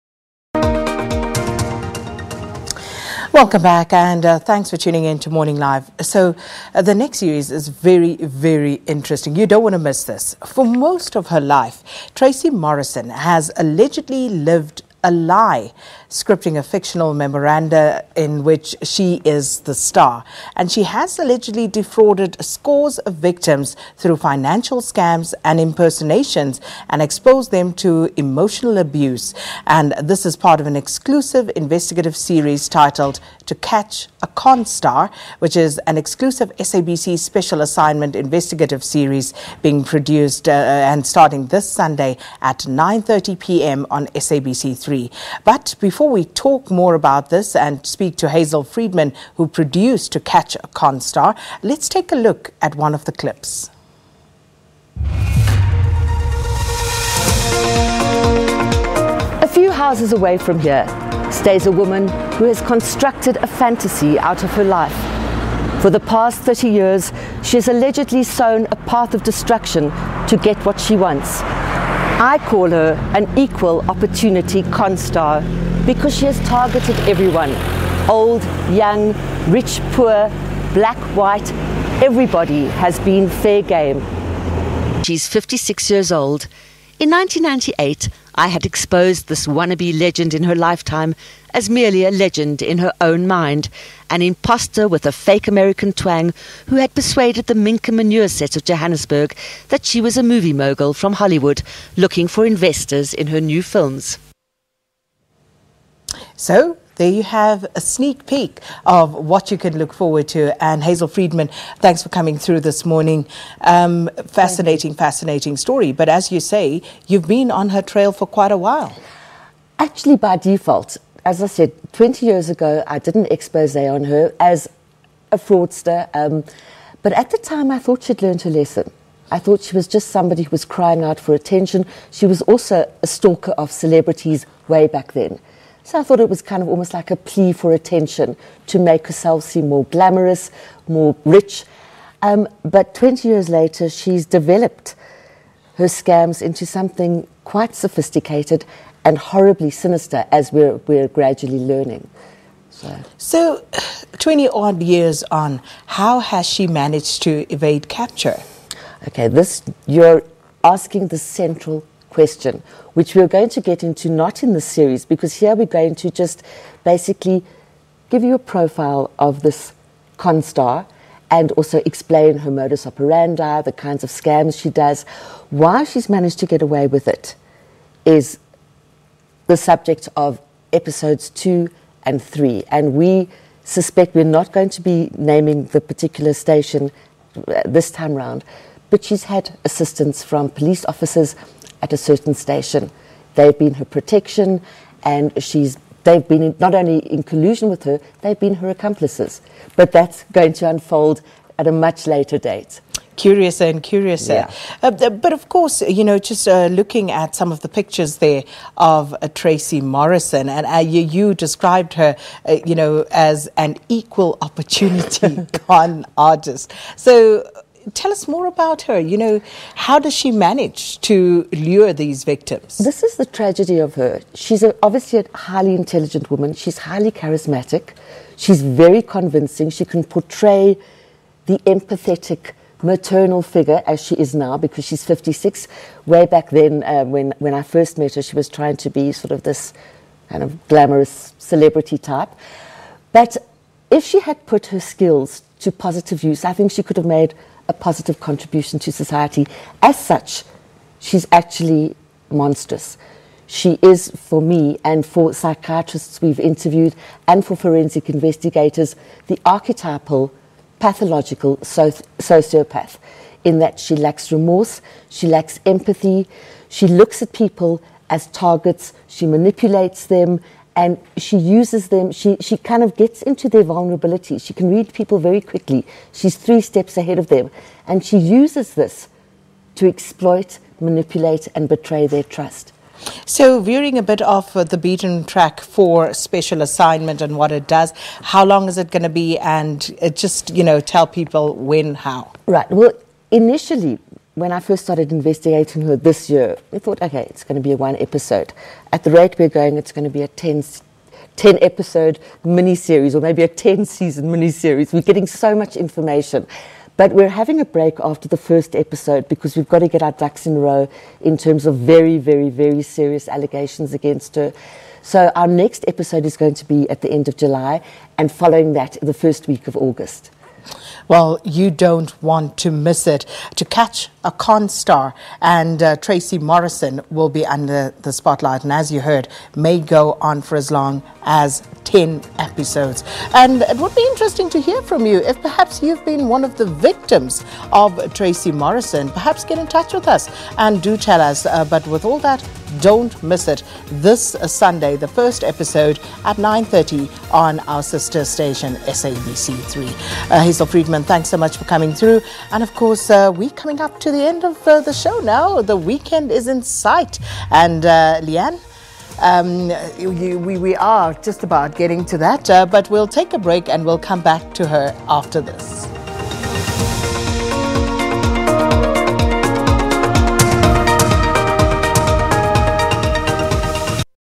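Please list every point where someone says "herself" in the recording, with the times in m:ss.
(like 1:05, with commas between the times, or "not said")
2:19.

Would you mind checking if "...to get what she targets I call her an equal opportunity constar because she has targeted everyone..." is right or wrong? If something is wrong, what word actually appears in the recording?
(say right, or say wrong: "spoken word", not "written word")
wrong: "wants", not "targets".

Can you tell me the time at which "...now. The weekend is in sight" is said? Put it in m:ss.
5:55.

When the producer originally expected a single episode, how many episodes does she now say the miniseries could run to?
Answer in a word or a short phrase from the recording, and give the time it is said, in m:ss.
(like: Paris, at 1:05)
10, at 5:01.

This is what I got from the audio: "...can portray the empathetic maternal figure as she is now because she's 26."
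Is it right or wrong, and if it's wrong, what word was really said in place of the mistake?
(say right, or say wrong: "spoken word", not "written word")
wrong: "56", not "26".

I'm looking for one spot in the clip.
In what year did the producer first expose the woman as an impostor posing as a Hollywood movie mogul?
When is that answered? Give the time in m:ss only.
1:27.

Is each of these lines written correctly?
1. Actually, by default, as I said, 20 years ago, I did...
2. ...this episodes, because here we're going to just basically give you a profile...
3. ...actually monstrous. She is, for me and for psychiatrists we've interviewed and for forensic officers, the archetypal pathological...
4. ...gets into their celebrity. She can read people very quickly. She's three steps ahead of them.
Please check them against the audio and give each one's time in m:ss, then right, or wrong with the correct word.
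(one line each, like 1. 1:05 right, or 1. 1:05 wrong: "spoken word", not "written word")
1. 1:59 right
2. 2:44 wrong: "series", not "episodes"
3. 4:11 wrong: "investigators", not "officers"
4. 4:32 wrong: "vulnerability", not "celebrity".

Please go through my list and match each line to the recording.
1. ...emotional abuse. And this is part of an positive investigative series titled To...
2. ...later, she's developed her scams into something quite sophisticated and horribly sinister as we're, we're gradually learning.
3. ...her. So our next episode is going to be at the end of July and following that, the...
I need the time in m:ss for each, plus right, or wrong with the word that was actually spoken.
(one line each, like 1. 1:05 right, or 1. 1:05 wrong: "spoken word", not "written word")
1. 0:28 wrong: "exclusive", not "positive"
2. 2:23 right
3. 5:14 right.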